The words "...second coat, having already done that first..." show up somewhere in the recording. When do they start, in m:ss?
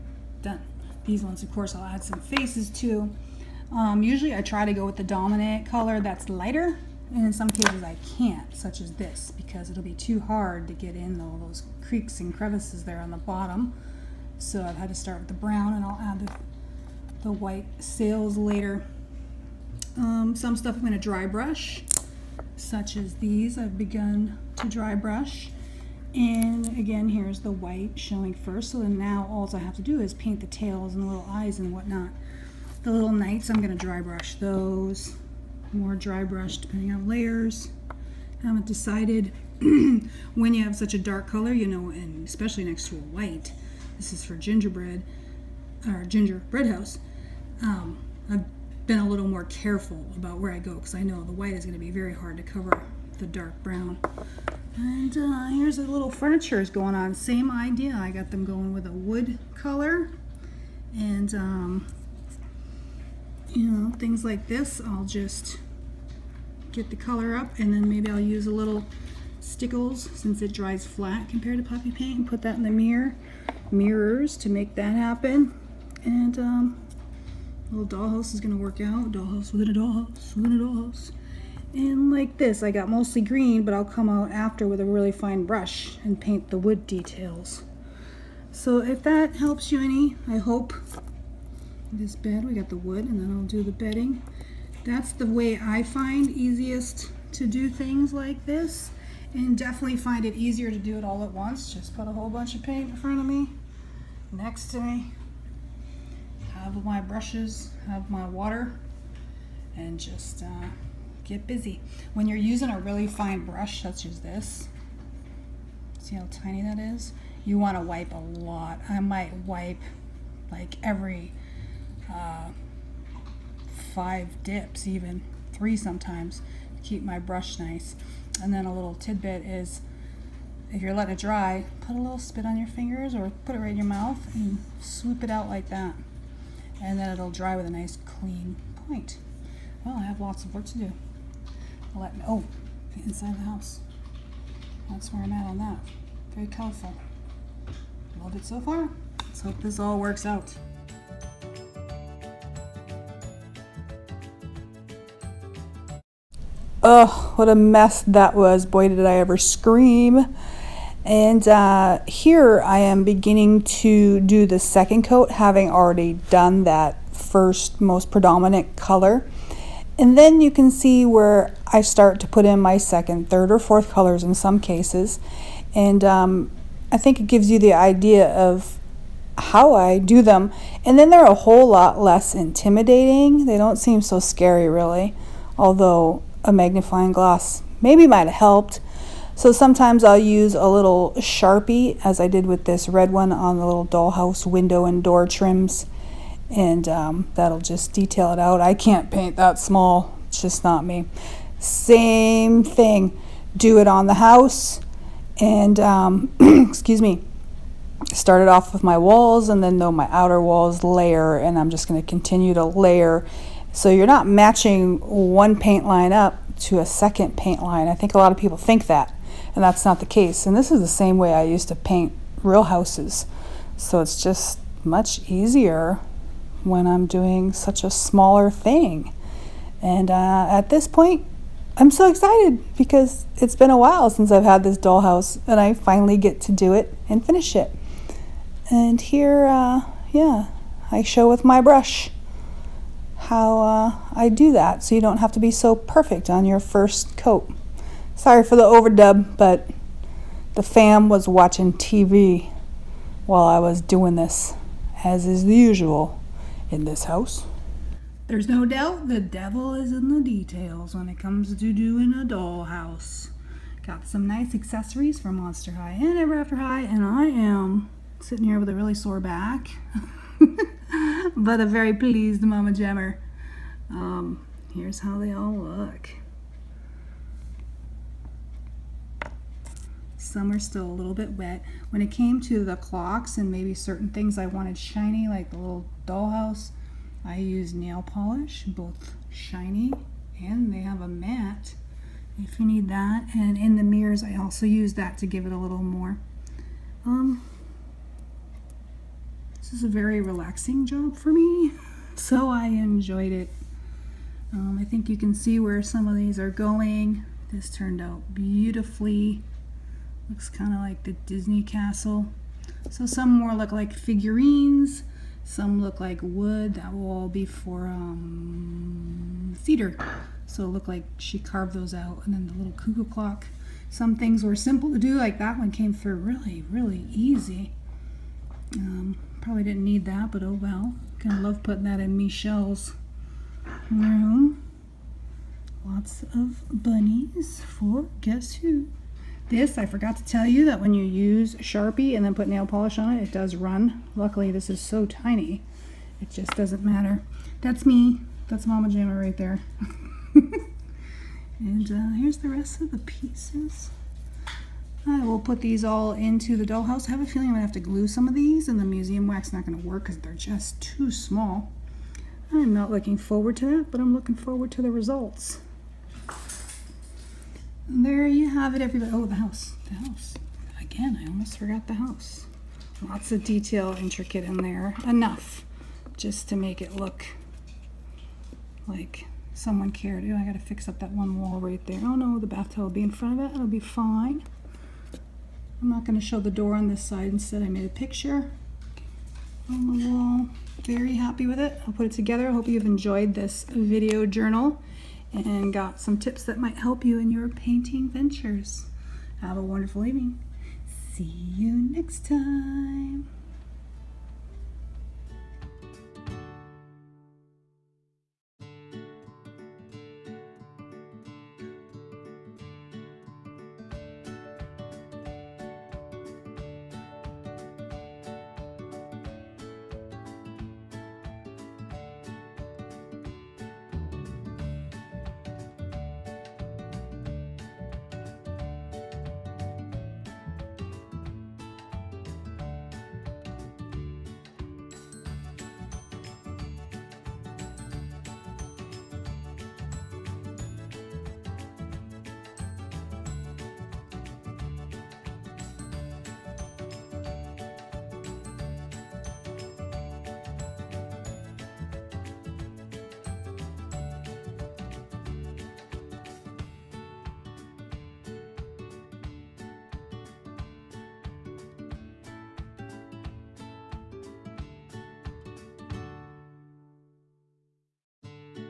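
2:44.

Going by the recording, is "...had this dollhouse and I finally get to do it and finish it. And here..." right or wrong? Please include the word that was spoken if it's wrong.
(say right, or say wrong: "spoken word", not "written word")
right.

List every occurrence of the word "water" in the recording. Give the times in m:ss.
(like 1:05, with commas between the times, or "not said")
1:48.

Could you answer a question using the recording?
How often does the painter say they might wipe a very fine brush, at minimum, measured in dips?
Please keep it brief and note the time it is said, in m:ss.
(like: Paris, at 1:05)
3, at 2:05.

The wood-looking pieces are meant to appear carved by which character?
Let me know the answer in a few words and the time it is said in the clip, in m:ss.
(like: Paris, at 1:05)
Cedar, at 5:19.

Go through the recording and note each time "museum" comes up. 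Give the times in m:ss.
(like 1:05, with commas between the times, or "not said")
5:58.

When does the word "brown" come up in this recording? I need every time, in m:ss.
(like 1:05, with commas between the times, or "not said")
0:15, 0:53.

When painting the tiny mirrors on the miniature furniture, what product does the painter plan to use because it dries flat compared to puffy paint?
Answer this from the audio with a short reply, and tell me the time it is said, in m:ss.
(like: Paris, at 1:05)
Stickles, at 1:09.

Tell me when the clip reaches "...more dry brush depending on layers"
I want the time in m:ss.
0:35.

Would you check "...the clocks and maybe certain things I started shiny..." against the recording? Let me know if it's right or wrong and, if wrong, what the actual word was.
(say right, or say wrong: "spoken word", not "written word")
wrong: "wanted", not "started".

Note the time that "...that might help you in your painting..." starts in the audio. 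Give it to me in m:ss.
6:36.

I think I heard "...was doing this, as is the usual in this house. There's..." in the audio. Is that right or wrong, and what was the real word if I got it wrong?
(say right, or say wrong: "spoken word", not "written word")
right.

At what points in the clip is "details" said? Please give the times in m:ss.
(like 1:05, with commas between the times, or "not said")
1:26, 3:17, 4:20, 6:13.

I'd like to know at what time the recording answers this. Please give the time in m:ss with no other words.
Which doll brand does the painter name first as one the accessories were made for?
4:25.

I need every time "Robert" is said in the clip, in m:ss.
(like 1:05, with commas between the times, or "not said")
not said.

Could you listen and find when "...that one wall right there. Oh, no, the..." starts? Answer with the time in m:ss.
6:20.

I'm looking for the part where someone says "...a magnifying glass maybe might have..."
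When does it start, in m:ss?
3:06.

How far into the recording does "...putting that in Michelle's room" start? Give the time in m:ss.
5:31.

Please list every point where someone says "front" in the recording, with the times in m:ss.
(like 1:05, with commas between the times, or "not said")
1:42, 6:23.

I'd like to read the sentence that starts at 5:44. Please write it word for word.
Luckily, this is so tiny, it just doesn't matter.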